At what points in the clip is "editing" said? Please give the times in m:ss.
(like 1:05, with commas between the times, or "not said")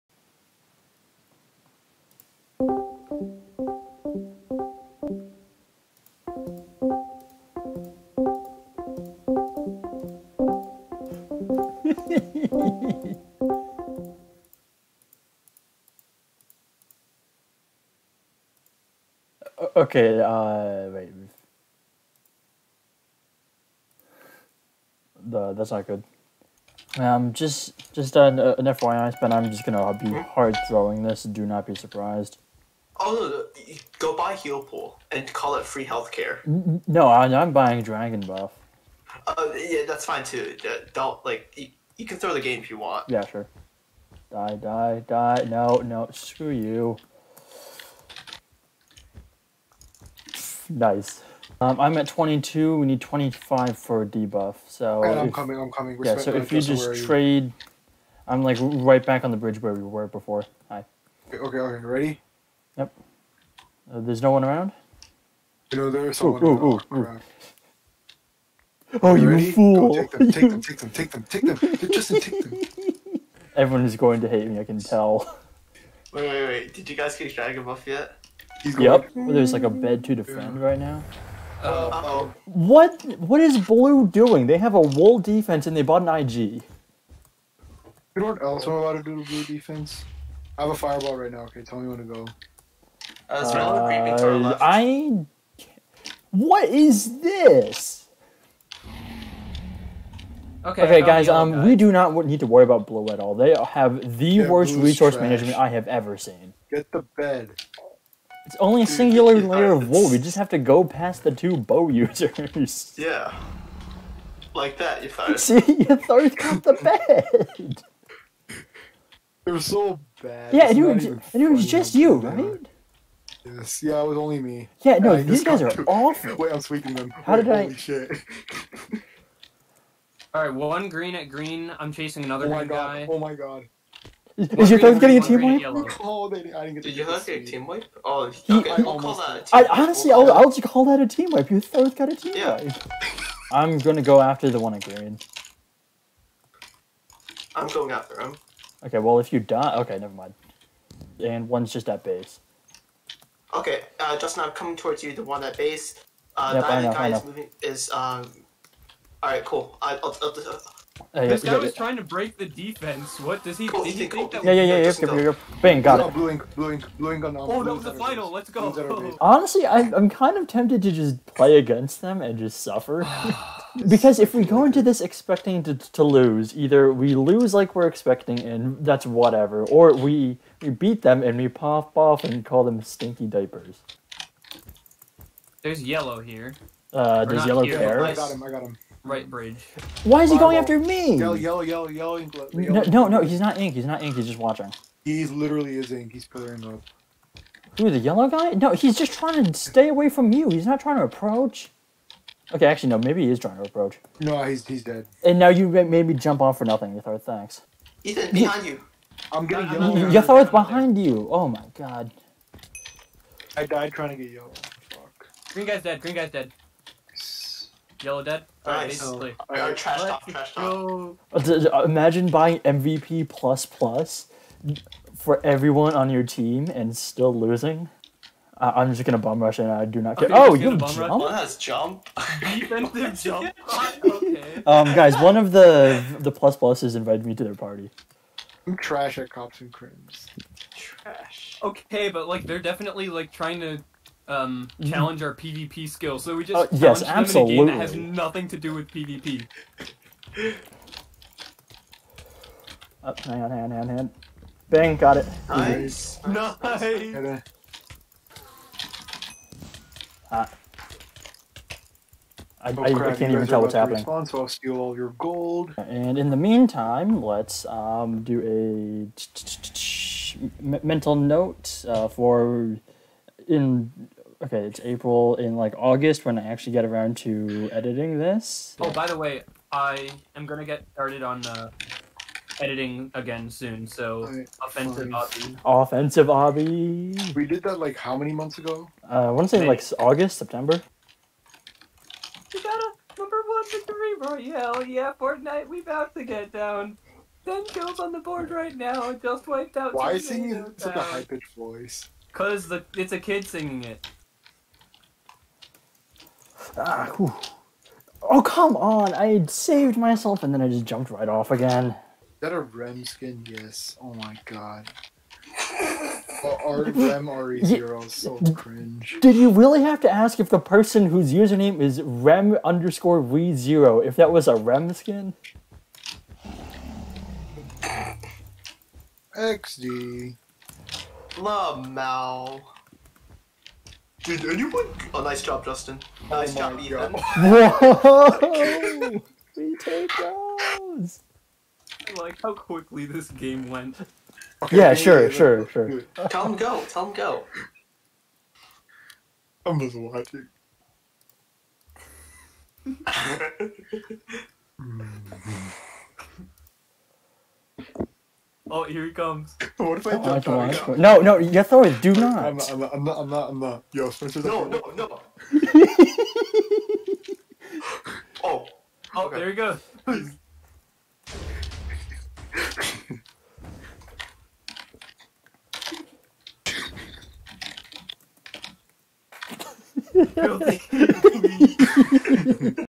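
4:37, 4:42.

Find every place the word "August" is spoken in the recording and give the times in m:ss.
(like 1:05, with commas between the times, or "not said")
4:35, 4:49.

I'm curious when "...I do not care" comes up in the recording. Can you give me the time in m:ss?
3:49.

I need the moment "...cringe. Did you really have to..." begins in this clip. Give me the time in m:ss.
5:18.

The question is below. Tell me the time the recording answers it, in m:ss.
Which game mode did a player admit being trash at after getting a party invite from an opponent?
3:59.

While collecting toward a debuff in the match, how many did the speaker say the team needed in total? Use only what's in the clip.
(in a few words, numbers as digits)
25.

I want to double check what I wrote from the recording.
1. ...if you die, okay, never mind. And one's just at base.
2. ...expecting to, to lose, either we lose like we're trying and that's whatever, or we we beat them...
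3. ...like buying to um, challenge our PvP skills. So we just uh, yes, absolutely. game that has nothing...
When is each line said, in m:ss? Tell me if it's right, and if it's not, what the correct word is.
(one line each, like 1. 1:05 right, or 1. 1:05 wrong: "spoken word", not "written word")
1. 2:29 right
2. 2:55 wrong: "expecting", not "trying"
3. 4:03 wrong: "trying", not "buying".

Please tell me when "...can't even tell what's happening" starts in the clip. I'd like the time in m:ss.
4:23.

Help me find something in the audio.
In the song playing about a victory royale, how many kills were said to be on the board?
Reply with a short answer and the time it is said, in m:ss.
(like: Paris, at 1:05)
10, at 4:57.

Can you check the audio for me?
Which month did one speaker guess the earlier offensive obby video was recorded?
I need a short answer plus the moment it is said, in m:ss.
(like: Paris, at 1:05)
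May, at 4:49.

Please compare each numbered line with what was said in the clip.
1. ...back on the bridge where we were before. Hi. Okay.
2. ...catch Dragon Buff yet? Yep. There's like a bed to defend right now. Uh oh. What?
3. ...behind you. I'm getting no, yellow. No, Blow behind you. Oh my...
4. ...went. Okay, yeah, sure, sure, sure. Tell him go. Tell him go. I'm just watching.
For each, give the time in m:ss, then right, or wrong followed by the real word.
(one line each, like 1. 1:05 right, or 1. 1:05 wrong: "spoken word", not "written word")
1. 0:59 right
2. 1:17 right
3. 3:28 wrong: "Yatharth", not "Blow"
4. 5:43 right.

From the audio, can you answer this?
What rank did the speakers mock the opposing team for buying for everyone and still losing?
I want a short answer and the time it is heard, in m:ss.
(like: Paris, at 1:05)
MVP plus plus, at 3:42.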